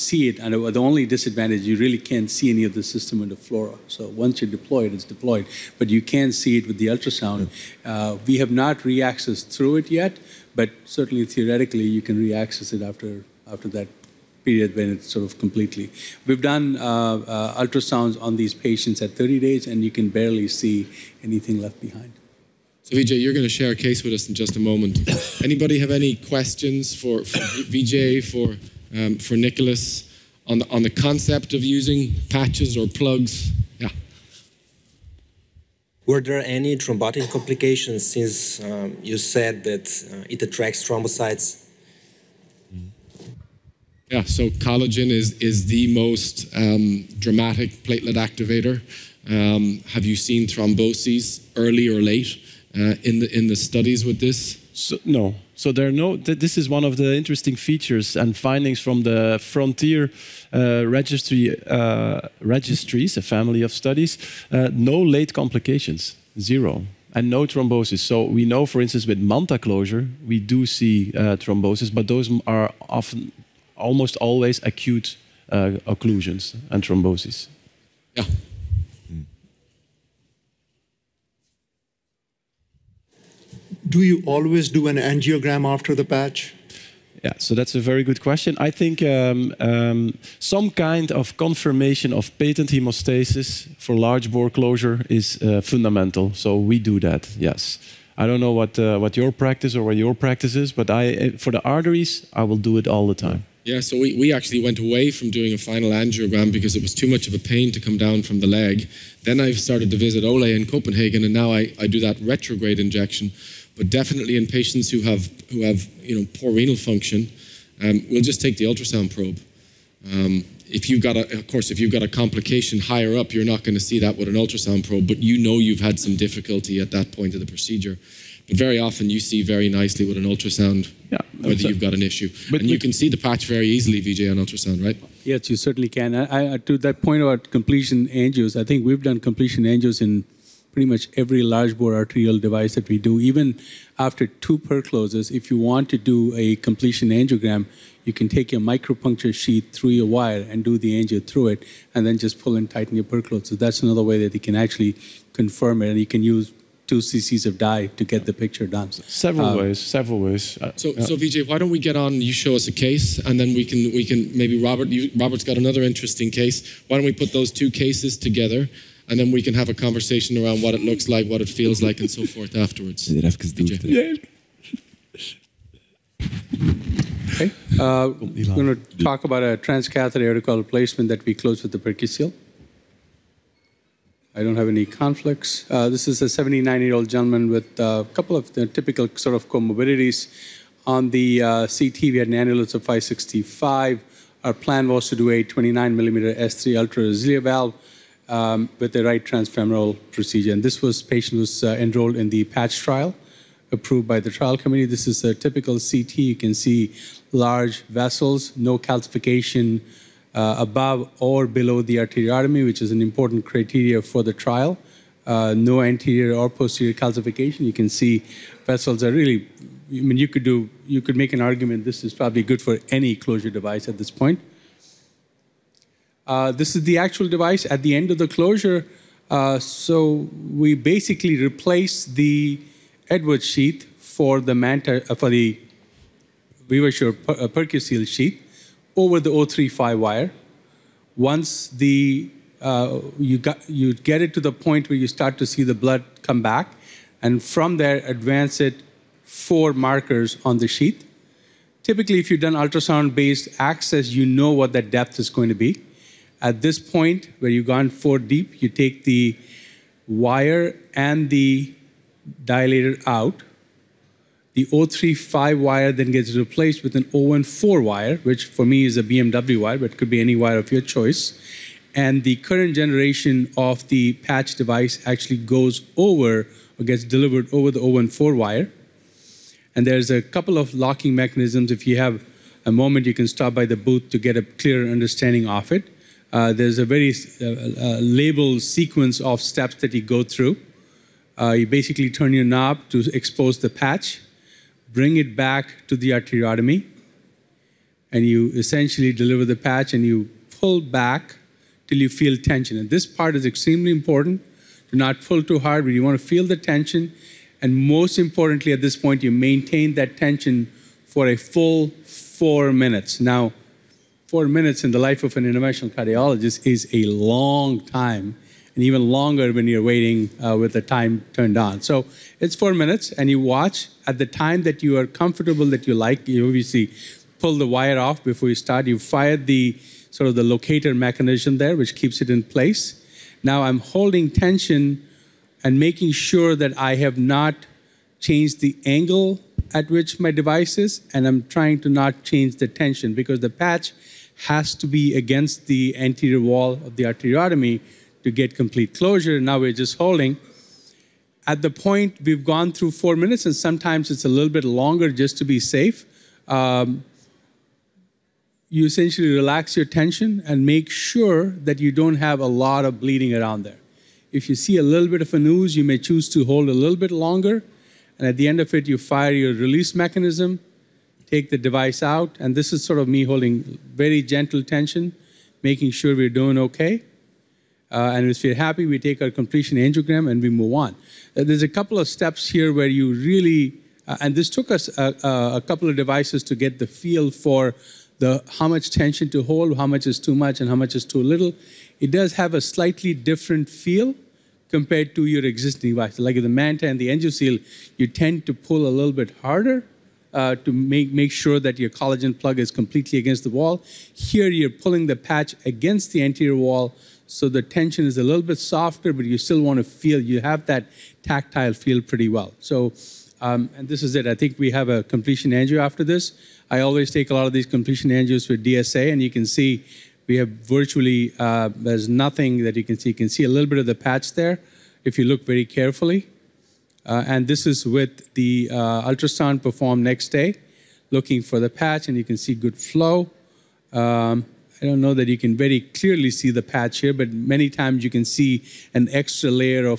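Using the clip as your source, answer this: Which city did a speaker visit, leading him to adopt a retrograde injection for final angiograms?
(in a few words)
Copenhagen.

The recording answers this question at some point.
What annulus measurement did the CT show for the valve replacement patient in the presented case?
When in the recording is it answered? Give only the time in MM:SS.
03:12.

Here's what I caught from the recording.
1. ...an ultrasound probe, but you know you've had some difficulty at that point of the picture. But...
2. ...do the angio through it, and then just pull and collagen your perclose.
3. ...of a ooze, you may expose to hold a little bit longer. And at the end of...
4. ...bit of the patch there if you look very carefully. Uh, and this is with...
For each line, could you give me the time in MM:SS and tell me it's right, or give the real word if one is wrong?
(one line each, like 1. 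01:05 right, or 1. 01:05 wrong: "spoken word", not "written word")
1. 02:04 wrong: "procedure", not "picture"
2. 02:30 wrong: "tighten", not "collagen"
3. 06:05 wrong: "choose", not "expose"
4. 07:03 right.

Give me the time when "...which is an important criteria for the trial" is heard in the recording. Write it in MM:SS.
03:32.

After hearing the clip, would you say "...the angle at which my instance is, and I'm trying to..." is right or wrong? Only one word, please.
wrong.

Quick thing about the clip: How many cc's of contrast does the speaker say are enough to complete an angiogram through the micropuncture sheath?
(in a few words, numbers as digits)
2.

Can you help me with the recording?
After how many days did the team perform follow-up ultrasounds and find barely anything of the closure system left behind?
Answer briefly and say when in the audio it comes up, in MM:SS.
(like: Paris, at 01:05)
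30, at 00:19.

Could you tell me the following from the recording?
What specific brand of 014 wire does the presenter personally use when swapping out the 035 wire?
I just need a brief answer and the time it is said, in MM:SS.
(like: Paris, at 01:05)
BMW, at 04:29.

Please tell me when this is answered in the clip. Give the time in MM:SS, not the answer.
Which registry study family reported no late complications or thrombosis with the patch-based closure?
00:59.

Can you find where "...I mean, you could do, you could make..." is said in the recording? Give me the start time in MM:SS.
03:39.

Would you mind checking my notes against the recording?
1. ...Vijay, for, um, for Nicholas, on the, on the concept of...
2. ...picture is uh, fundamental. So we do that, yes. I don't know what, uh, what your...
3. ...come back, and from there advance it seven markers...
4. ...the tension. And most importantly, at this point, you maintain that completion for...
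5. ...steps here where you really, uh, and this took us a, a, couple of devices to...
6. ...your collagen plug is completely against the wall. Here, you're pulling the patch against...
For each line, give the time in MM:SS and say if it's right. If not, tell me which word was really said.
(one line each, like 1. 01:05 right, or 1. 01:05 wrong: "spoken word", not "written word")
1. 00:27 right
2. 01:34 wrong: "closure", not "picture"
3. 04:06 wrong: "four", not "seven"
4. 05:06 wrong: "tension", not "completion"
5. 06:22 right
6. 06:41 right.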